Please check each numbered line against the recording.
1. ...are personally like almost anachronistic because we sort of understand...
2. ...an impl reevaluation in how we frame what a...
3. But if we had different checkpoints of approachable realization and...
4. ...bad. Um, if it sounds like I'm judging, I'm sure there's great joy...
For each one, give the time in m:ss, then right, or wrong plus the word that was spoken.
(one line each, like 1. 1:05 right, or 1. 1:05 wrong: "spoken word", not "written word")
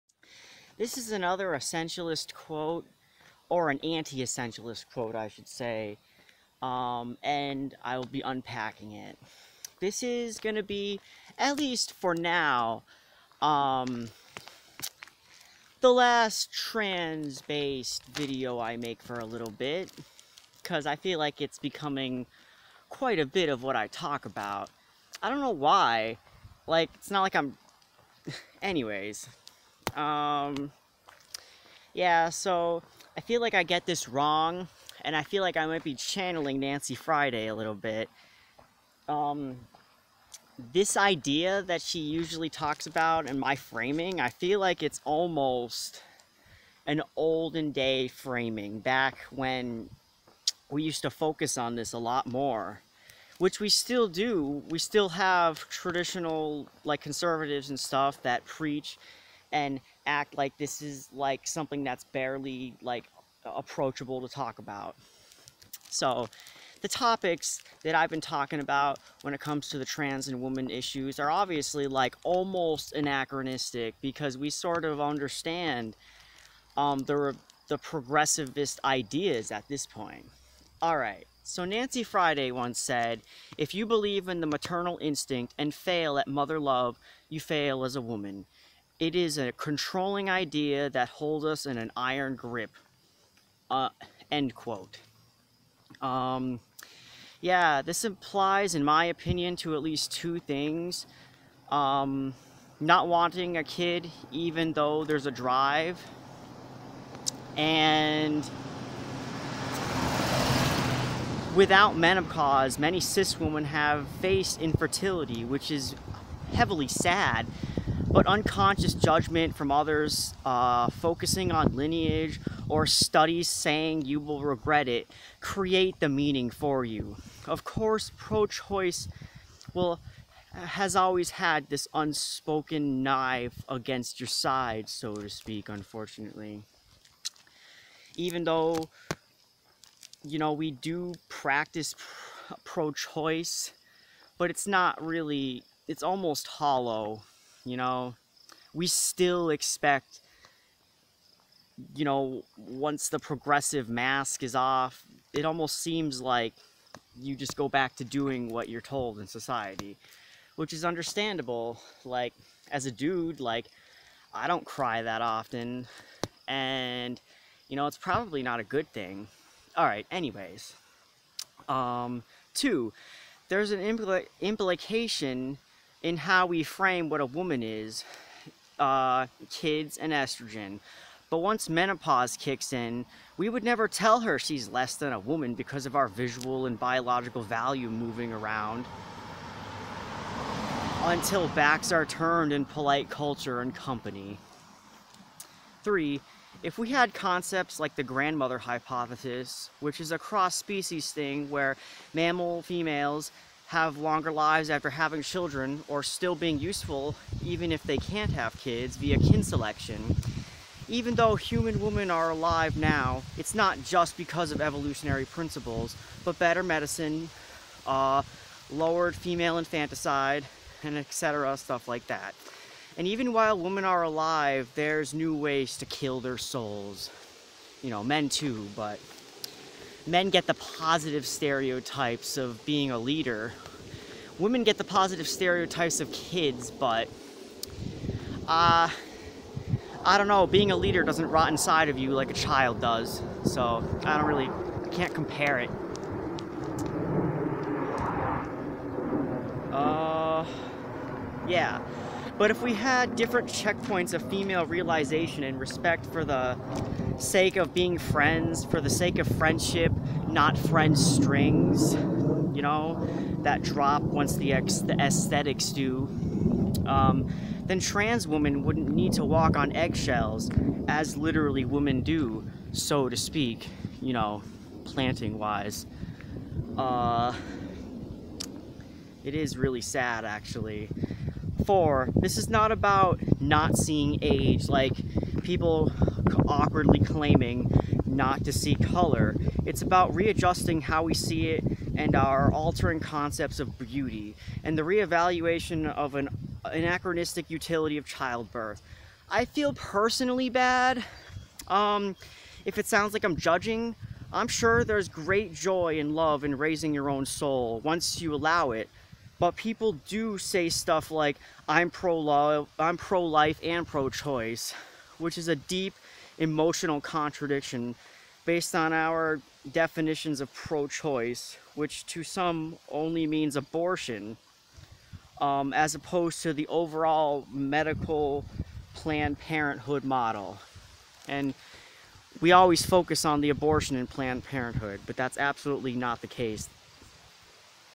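1. 1:11 wrong: "obviously", not "personally"
2. 2:53 wrong: "implication", not "reevaluation"
3. 4:12 wrong: "female", not "approachable"
4. 5:00 right.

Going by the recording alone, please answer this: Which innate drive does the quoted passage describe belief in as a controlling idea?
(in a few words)
maternal instinct.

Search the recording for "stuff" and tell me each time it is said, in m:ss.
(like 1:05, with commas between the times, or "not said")
0:57, 3:41, 5:10.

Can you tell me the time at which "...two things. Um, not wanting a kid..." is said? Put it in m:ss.
1:40.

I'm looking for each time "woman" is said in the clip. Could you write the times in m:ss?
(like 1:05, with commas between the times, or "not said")
1:28, 2:57, 3:05.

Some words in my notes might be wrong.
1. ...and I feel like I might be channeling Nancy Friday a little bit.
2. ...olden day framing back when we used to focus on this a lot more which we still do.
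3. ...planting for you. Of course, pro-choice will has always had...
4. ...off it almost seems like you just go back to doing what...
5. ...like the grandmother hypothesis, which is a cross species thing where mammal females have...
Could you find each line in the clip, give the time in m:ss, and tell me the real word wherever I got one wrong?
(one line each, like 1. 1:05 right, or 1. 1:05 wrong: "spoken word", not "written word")
1. 0:35 right
2. 0:47 right
3. 2:06 wrong: "meaning", not "planting"
4. 2:34 right
5. 3:17 right.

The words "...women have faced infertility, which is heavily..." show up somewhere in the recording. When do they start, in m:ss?
1:53.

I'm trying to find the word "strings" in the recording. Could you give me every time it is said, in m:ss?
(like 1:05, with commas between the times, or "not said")
4:20.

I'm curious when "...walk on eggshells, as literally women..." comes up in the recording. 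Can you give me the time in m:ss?
4:29.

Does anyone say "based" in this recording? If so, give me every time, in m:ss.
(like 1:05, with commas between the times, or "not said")
0:16, 5:18.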